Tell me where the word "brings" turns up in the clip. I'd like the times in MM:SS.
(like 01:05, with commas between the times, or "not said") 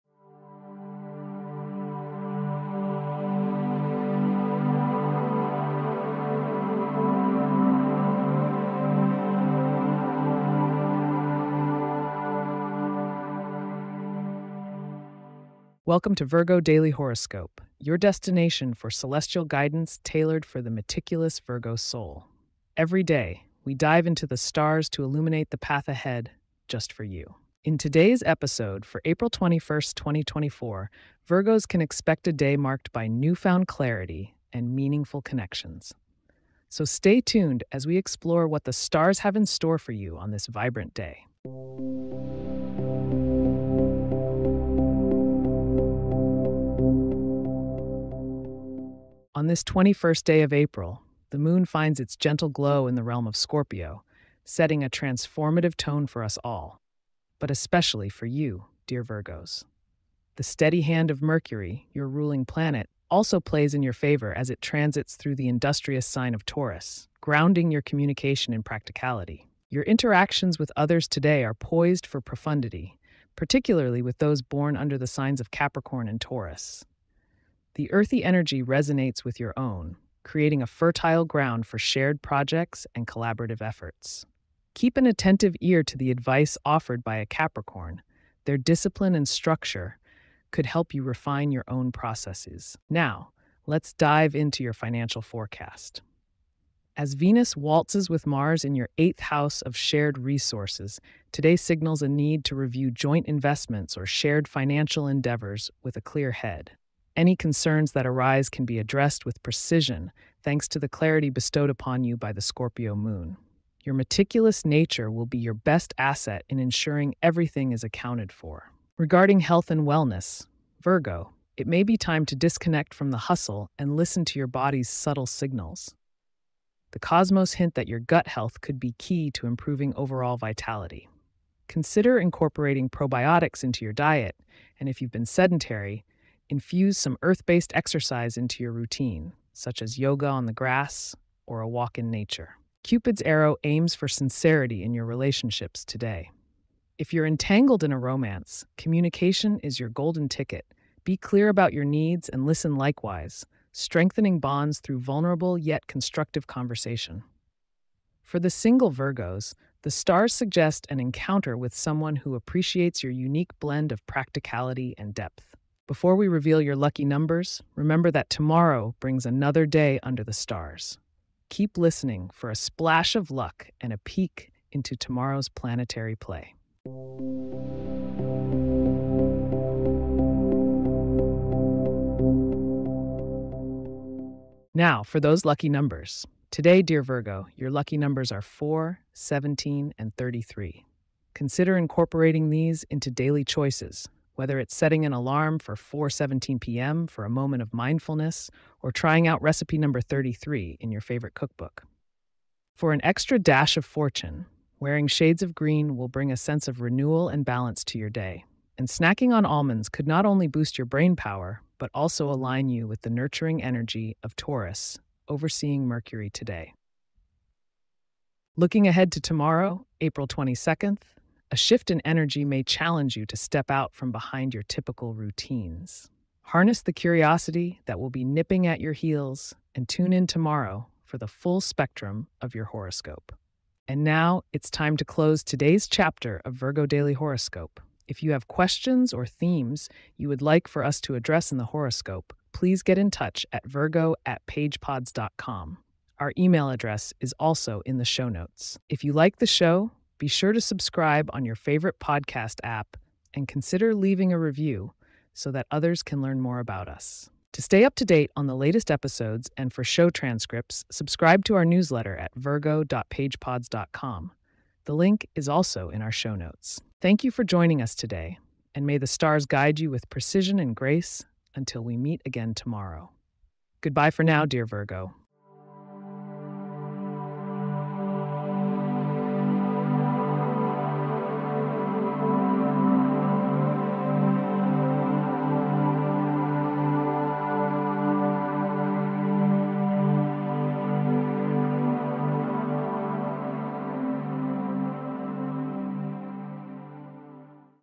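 02:49, 03:26.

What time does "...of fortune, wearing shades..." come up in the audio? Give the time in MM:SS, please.
03:23.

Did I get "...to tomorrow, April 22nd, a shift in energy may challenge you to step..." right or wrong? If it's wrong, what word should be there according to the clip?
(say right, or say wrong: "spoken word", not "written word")
right.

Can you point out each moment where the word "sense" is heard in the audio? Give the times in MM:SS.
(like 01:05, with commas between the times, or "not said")
03:26.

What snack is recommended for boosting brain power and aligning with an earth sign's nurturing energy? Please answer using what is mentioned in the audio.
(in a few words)
Almonds.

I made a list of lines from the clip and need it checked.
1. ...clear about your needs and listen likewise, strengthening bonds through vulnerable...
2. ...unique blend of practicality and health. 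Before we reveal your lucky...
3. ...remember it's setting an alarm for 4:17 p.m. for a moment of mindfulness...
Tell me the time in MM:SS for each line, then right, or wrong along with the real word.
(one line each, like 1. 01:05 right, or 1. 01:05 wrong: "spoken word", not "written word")
1. 02:31 right
2. 02:43 wrong: "depth", not "health"
3. 03:14 wrong: "whether", not "remember".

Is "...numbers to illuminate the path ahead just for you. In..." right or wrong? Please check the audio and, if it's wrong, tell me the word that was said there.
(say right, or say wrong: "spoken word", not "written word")
wrong: "stars", not "numbers".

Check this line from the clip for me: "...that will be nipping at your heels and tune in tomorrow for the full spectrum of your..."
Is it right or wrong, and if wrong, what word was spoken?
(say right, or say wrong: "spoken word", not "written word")
right.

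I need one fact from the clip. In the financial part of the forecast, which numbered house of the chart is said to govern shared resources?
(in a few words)
Eighth house.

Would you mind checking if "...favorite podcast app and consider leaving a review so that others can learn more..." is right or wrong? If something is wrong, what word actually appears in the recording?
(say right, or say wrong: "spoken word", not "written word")
right.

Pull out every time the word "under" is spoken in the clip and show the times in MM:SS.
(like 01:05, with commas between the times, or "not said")
01:14, 02:50.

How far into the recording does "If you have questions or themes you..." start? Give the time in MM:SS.
03:58.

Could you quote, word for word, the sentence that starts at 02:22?
Cupid's arrow aims for sincerity in your relationships today.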